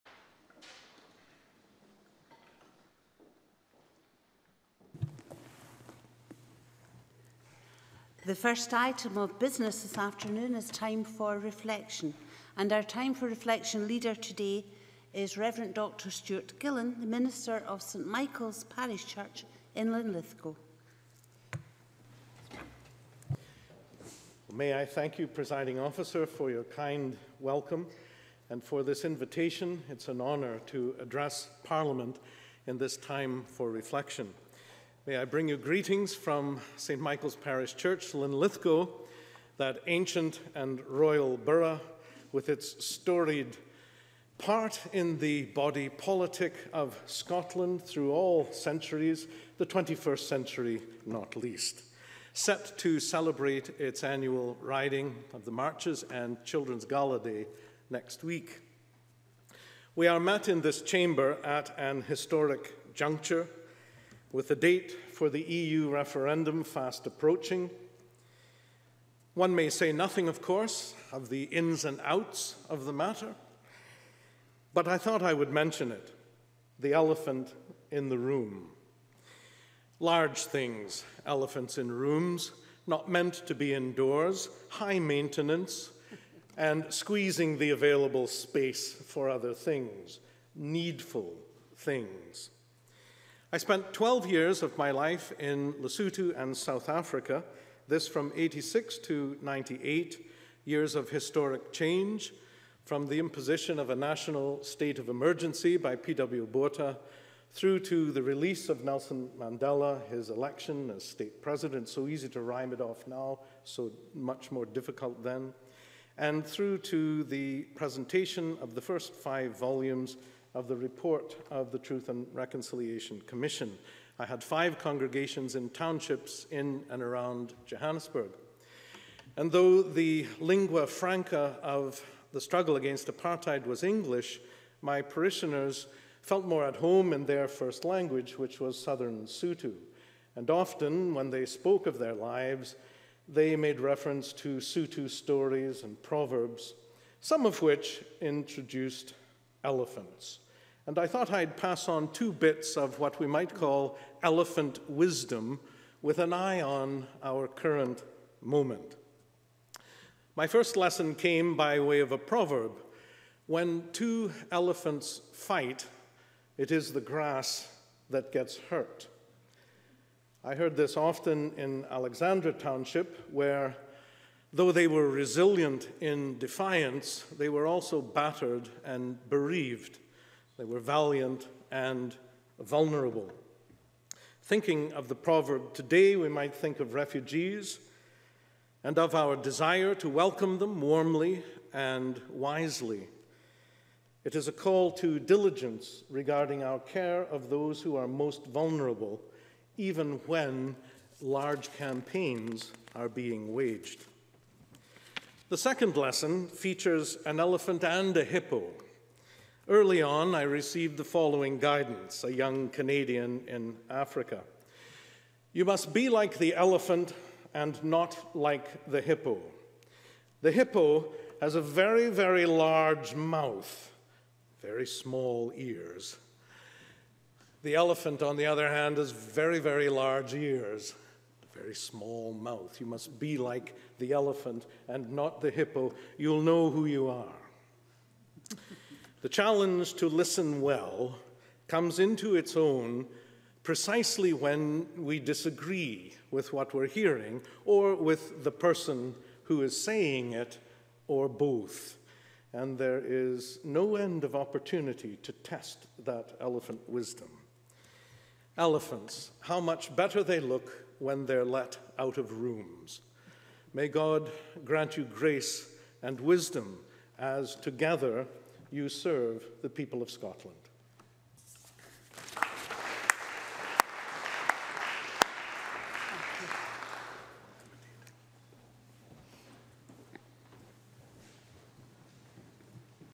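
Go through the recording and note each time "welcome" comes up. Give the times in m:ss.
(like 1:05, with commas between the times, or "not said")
0:27, 3:10.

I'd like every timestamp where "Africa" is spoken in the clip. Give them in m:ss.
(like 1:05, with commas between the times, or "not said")
1:36, 3:33.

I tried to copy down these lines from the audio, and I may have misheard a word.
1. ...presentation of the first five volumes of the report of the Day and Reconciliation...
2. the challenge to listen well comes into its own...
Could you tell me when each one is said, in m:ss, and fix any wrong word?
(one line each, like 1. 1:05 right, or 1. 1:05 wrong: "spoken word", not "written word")
1. 1:57 wrong: "Truth", not "Day"
2. 3:59 right.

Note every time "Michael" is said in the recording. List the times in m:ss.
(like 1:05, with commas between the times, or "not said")
0:18, 0:37.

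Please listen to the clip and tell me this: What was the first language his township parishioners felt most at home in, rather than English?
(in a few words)
Southern Sotho.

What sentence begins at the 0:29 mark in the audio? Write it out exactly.
It's an honour to address Parliament in this time for reflection.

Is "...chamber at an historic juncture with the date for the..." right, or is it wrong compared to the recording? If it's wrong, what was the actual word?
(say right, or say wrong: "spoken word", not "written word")
right.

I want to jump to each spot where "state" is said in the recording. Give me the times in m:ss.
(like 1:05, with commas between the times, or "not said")
1:44, 1:51.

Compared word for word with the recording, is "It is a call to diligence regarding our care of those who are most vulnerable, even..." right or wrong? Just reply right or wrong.
right.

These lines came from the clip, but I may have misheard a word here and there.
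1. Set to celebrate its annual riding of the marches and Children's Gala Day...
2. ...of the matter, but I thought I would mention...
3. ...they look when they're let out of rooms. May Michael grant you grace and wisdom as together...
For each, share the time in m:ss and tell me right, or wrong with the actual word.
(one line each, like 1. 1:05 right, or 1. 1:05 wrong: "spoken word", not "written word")
1. 0:52 right
2. 1:12 right
3. 4:20 wrong: "God", not "Michael".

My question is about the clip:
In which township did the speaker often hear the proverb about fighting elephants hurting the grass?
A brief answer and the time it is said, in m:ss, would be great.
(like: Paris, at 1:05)
Alexandra Township, at 2:51.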